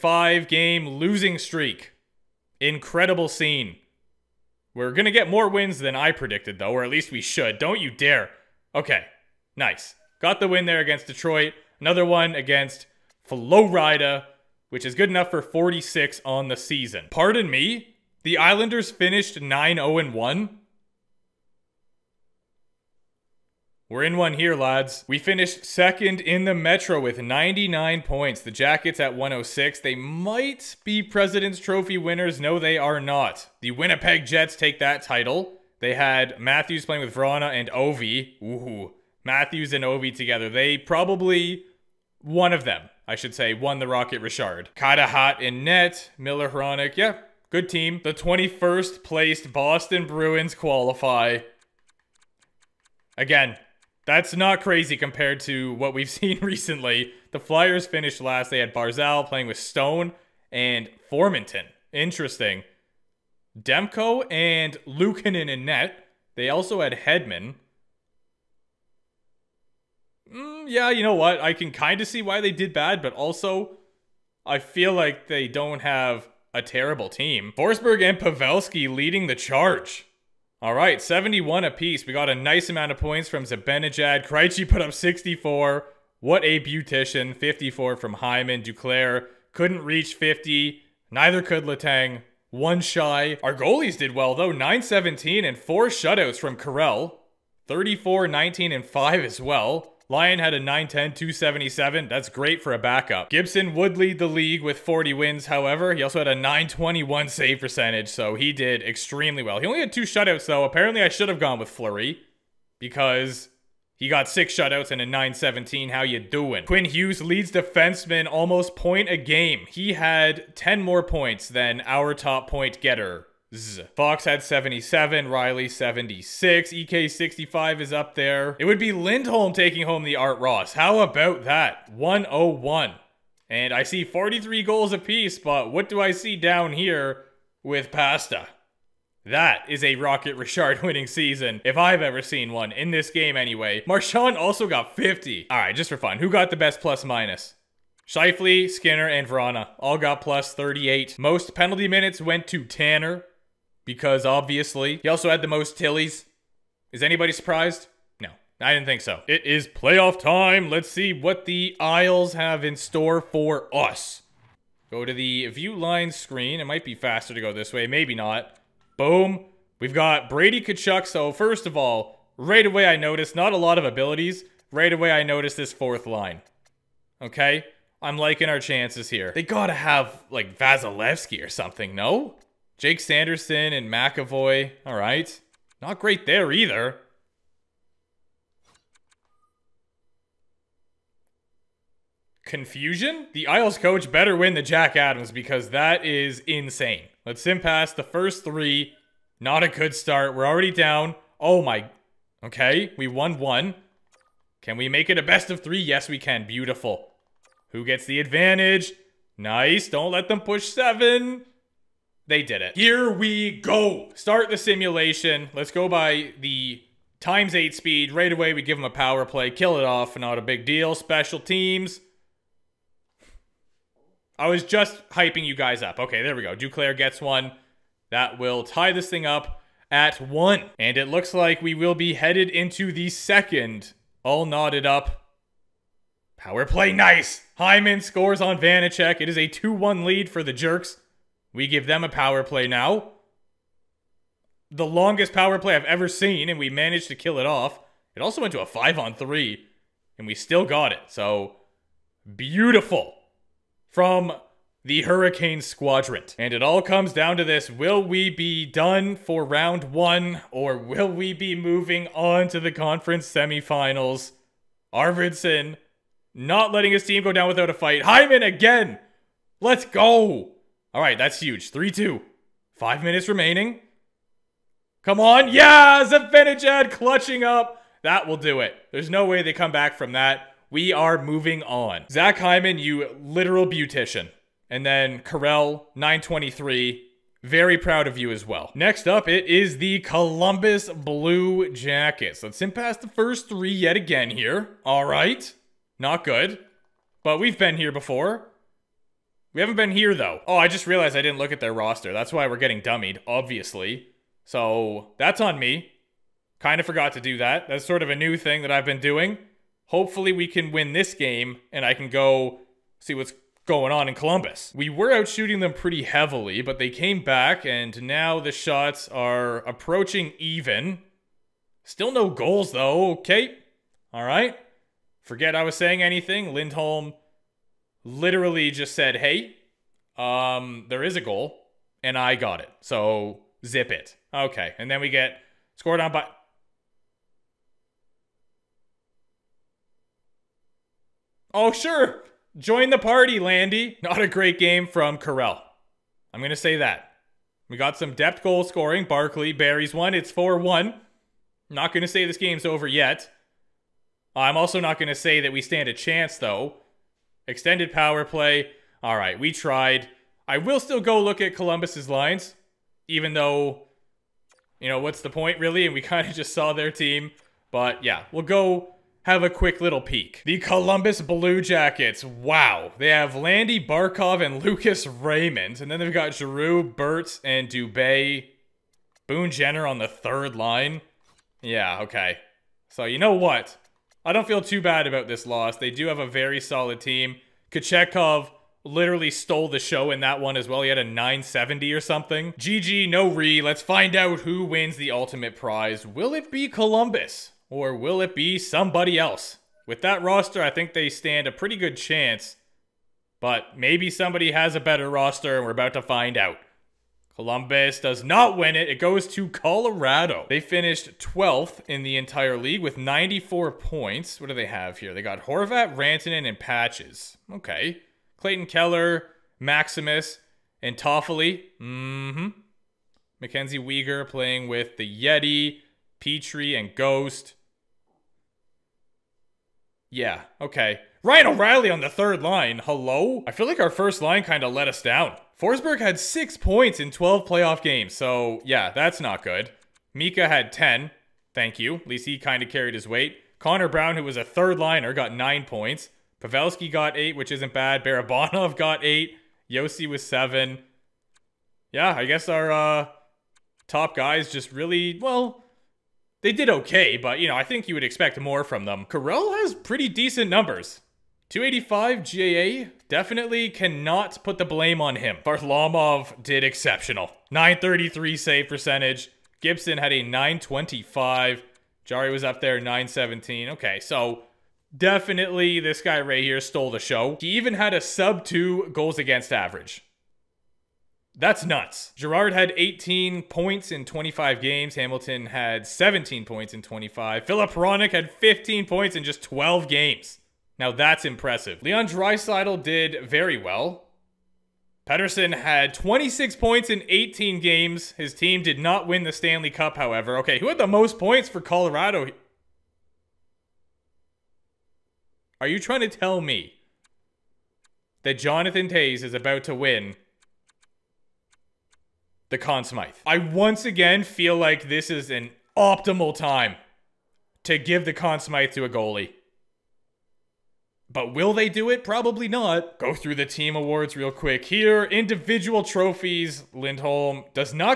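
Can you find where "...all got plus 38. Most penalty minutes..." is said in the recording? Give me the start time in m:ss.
2:29.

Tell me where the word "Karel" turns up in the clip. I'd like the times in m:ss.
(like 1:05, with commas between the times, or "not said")
1:36, 4:45, 5:45, 7:39.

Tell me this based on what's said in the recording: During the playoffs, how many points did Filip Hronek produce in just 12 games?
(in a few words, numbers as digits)
15.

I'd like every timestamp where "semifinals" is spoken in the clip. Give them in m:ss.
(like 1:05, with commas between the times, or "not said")
4:23.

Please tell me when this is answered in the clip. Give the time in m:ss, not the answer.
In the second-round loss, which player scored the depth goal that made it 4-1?
5:49.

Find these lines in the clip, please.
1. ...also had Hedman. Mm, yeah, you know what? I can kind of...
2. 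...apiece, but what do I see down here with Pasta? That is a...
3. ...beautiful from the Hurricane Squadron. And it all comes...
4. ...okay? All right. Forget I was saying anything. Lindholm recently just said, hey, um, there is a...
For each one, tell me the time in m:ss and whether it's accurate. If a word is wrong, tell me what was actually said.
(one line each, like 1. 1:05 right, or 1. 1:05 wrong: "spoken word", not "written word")
1. 1:06 right
2. 2:14 right
3. 4:12 right
4. 5:23 wrong: "literally", not "recently".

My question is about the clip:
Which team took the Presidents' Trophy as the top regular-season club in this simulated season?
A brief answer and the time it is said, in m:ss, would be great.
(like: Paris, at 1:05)
Winnipeg Jets, at 0:33.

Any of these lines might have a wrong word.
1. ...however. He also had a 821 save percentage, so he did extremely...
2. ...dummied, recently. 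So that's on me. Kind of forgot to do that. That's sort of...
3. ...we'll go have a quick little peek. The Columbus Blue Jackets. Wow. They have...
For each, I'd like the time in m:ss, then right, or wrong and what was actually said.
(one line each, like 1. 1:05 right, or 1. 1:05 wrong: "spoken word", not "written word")
1. 1:45 wrong: "921", not "821"
2. 5:02 wrong: "obviously", not "recently"
3. 6:08 right.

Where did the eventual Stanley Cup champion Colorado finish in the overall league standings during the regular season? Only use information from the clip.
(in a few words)
12th.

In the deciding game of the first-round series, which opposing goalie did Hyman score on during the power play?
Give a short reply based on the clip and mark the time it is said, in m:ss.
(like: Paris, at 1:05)
Vanecek, at 3:58.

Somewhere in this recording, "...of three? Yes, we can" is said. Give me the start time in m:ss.
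3:25.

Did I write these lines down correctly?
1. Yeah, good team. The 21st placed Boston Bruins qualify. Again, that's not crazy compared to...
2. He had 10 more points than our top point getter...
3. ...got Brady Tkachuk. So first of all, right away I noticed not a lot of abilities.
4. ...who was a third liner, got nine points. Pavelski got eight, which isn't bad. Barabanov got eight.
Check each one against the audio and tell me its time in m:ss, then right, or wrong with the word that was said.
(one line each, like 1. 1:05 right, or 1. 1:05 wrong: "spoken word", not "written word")
1. 0:46 right
2. 1:59 right
3. 2:49 right
4. 7:24 right.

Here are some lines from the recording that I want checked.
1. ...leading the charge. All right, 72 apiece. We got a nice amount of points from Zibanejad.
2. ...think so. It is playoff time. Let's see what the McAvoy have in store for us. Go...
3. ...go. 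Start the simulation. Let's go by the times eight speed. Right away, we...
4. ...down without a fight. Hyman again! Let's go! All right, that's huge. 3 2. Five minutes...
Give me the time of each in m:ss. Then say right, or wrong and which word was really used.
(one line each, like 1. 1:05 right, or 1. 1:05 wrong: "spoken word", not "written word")
1. 1:18 wrong: "71", not "72"
2. 2:38 wrong: "Isles", not "McAvoy"
3. 3:33 right
4. 4:27 right.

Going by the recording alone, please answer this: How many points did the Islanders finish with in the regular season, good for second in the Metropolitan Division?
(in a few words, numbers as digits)
99.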